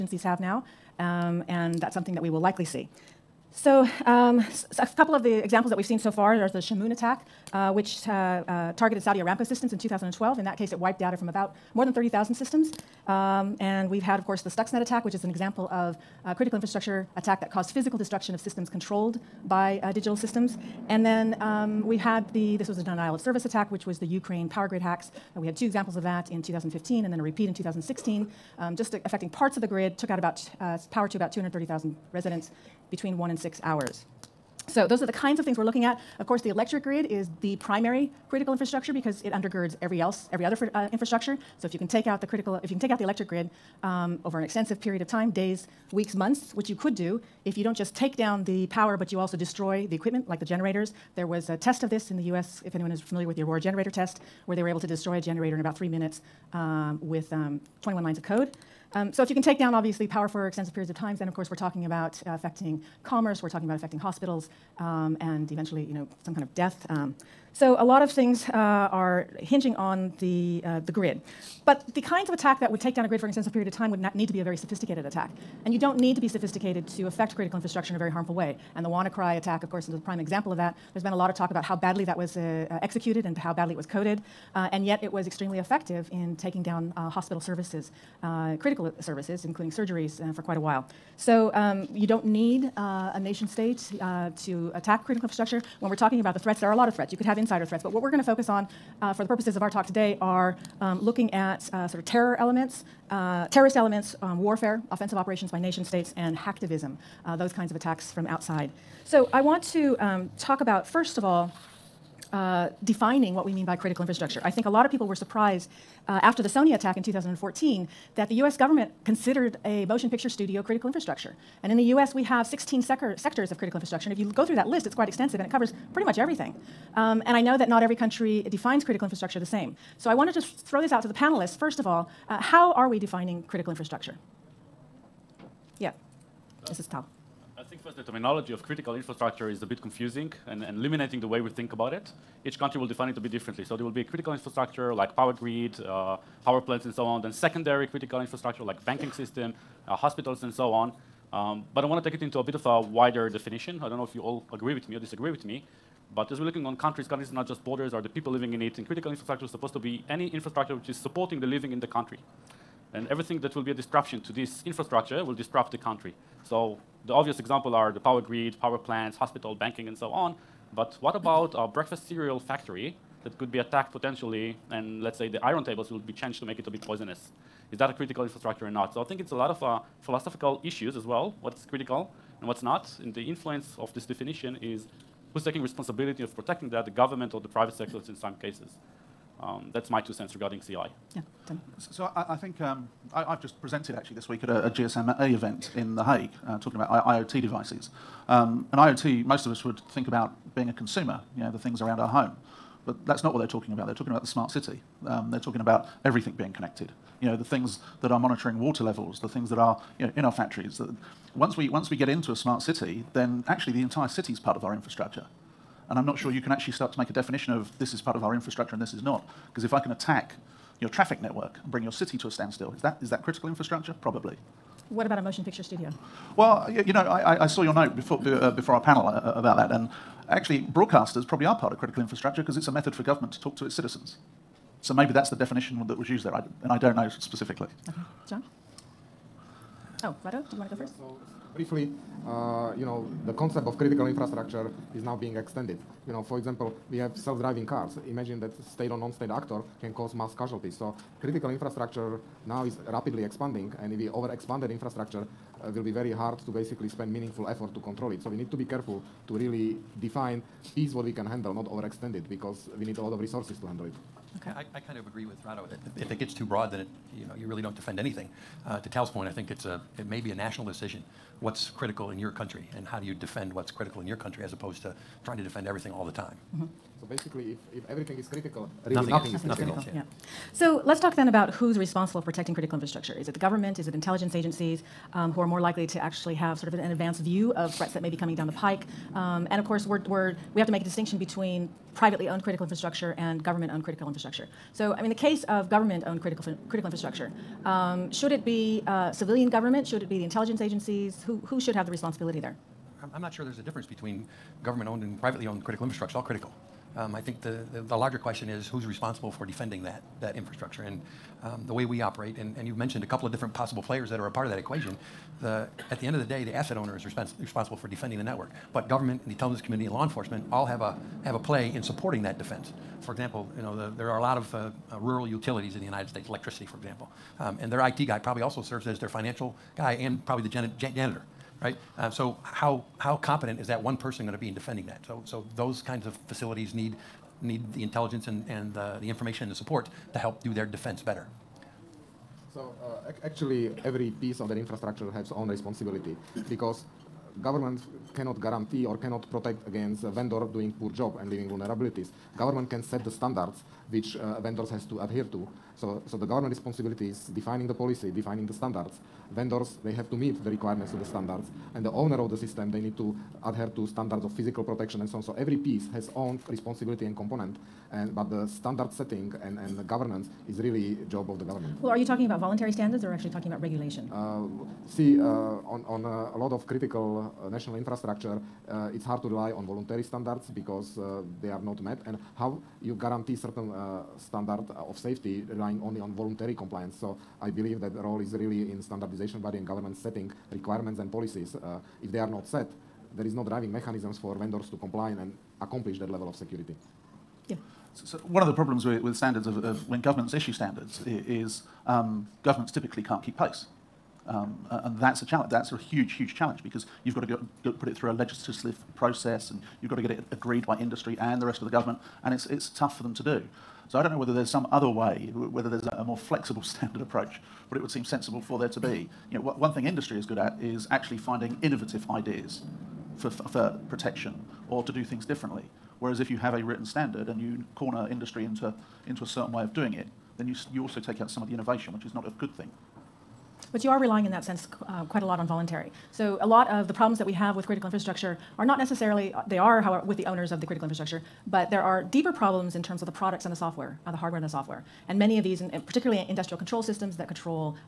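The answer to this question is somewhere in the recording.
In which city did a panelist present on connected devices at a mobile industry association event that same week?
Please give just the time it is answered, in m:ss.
3:15.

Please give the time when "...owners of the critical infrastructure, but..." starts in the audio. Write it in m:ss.
7:20.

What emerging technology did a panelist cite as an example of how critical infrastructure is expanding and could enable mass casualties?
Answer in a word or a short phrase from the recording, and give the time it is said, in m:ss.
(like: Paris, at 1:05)
Self-driving cars, at 4:07.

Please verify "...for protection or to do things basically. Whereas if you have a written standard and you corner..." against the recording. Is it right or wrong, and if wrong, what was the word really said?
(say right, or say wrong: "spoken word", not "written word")
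wrong: "differently", not "basically".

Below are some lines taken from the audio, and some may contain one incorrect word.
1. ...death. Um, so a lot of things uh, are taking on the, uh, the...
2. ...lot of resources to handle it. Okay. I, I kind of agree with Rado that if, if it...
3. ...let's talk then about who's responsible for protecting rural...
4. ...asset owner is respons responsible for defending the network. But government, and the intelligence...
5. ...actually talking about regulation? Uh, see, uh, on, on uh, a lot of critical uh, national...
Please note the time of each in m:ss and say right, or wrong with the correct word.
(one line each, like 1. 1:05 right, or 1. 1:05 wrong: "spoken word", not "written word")
1. 1:06 wrong: "hinging", not "taking"
2. 4:23 right
3. 4:40 wrong: "critical", not "rural"
4. 5:16 right
5. 6:13 right.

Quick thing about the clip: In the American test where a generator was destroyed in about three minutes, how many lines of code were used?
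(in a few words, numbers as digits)
21.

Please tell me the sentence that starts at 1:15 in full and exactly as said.
And you don't need to be sophisticated to affect critical infrastructure in a very harmful way.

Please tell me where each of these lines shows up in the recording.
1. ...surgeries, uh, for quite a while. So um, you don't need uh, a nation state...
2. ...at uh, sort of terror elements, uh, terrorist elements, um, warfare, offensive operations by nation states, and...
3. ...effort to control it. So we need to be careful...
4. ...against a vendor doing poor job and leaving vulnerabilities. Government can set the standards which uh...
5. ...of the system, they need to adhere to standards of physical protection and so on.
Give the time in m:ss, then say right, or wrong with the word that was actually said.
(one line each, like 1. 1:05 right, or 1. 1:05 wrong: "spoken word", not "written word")
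1. 1:29 right
2. 1:41 right
3. 4:17 right
4. 5:49 right
5. 6:02 right.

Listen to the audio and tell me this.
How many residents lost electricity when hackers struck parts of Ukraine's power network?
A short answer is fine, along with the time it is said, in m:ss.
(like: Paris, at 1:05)
230,000, at 0:31.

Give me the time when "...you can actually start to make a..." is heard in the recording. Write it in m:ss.
3:36.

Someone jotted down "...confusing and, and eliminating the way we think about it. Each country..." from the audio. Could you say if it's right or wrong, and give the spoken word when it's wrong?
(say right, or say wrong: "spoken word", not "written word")
right.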